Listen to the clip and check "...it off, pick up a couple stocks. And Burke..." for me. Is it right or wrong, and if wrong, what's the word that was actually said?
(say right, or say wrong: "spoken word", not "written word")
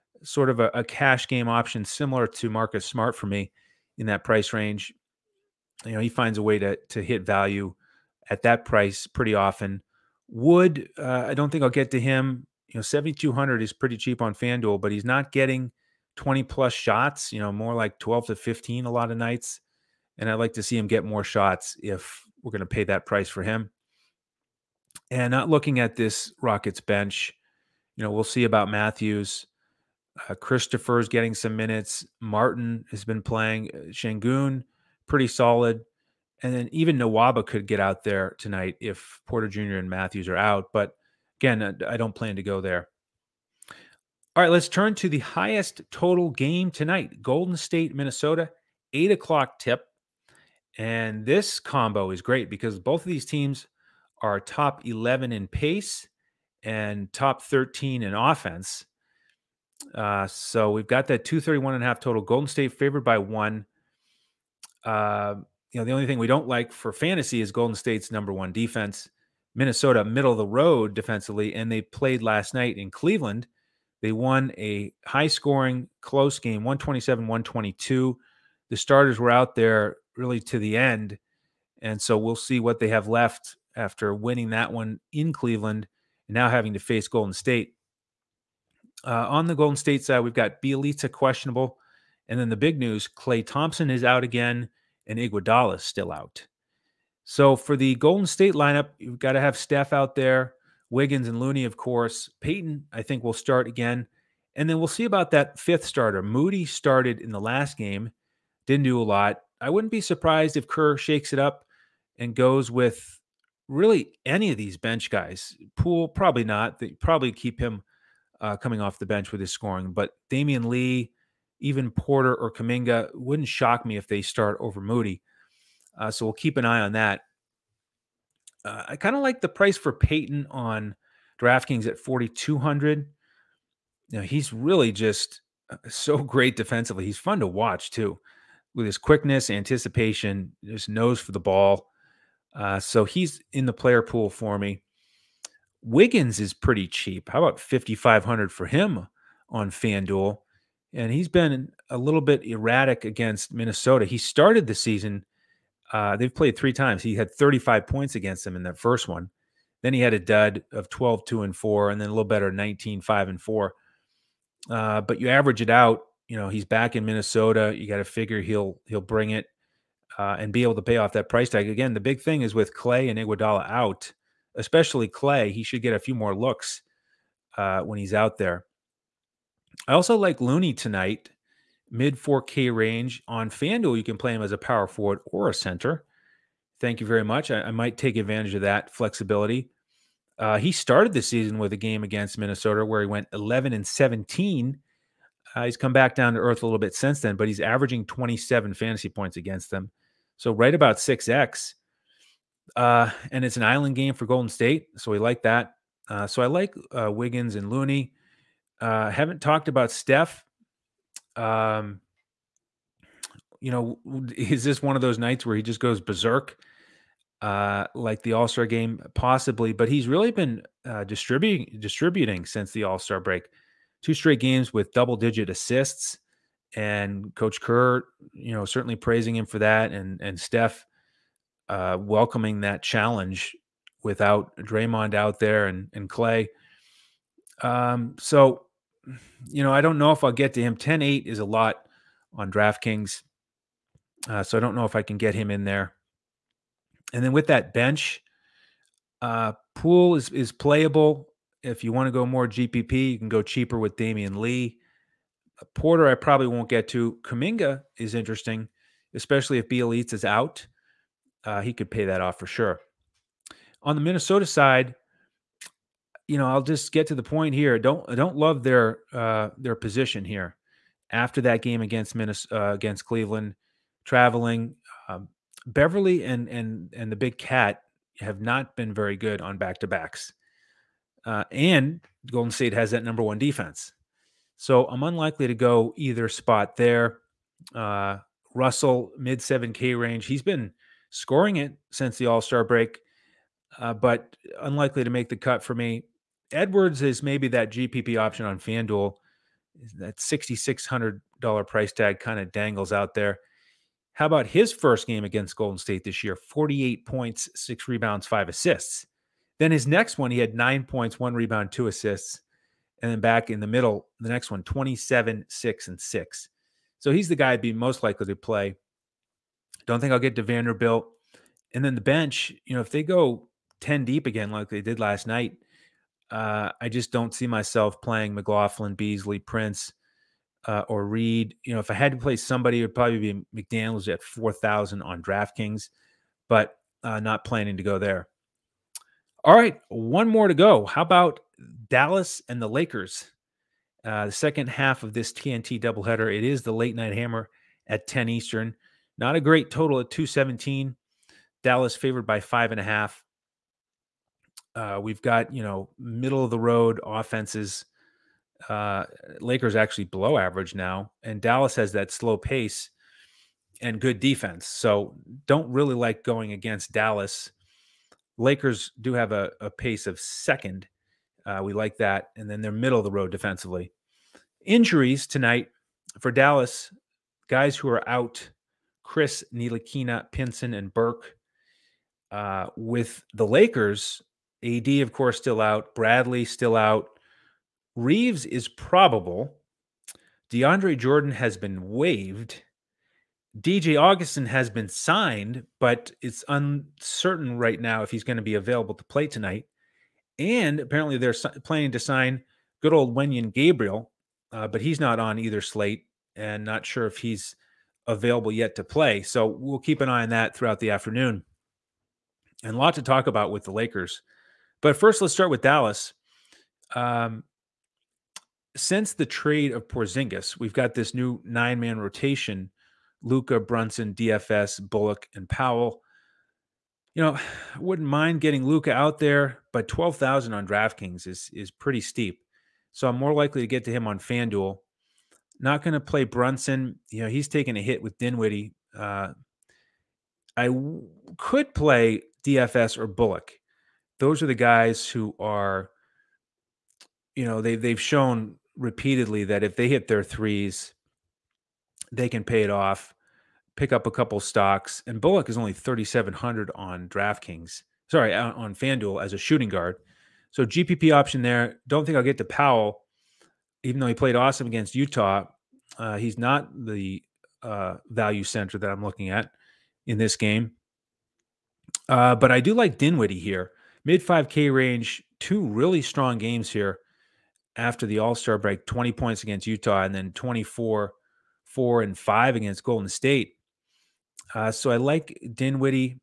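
wrong: "Bullock", not "Burke".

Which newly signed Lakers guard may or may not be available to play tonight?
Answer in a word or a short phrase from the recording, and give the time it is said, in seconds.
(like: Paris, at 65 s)
DJ Augustin, at 393 s.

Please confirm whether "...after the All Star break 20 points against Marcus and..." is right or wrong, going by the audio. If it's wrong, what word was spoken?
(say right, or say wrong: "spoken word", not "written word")
wrong: "Utah", not "Marcus".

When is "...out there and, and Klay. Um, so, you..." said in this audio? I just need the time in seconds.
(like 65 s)
235 s.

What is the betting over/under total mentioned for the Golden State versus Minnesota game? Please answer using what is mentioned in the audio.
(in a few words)
231.5.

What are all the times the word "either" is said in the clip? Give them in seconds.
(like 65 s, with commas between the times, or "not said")
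285 s, 405 s.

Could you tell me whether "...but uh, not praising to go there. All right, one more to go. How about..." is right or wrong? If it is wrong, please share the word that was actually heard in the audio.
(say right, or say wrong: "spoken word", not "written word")
wrong: "planning", not "praising".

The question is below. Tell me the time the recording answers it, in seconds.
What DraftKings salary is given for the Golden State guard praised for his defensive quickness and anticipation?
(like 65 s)
131 s.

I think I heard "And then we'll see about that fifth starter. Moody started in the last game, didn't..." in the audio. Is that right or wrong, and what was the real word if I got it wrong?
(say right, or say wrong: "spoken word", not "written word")
right.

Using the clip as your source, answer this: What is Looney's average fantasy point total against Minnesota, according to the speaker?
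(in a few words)
27.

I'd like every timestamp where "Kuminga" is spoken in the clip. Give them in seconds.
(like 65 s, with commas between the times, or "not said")
122 s, 257 s.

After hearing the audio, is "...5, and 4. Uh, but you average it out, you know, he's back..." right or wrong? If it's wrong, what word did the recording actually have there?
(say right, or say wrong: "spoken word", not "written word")
right.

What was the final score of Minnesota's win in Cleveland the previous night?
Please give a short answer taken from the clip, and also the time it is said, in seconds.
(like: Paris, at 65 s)
127-122, at 76 s.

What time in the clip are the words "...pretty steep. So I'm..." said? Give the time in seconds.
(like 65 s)
431 s.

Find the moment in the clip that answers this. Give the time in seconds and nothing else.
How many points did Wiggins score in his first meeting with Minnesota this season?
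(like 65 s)
157 s.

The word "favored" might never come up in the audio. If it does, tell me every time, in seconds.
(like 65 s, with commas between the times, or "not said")
62 s, 351 s.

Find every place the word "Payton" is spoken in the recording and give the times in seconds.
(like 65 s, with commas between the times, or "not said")
102 s, 129 s.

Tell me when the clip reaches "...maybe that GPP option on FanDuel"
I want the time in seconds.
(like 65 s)
297 s.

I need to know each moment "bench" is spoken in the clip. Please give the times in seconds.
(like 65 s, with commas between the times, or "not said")
26 s, 114 s, 119 s, 247 s, 322 s.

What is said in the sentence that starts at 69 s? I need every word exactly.
Minnesota, middle of the road defensively, and they played last night in Cleveland.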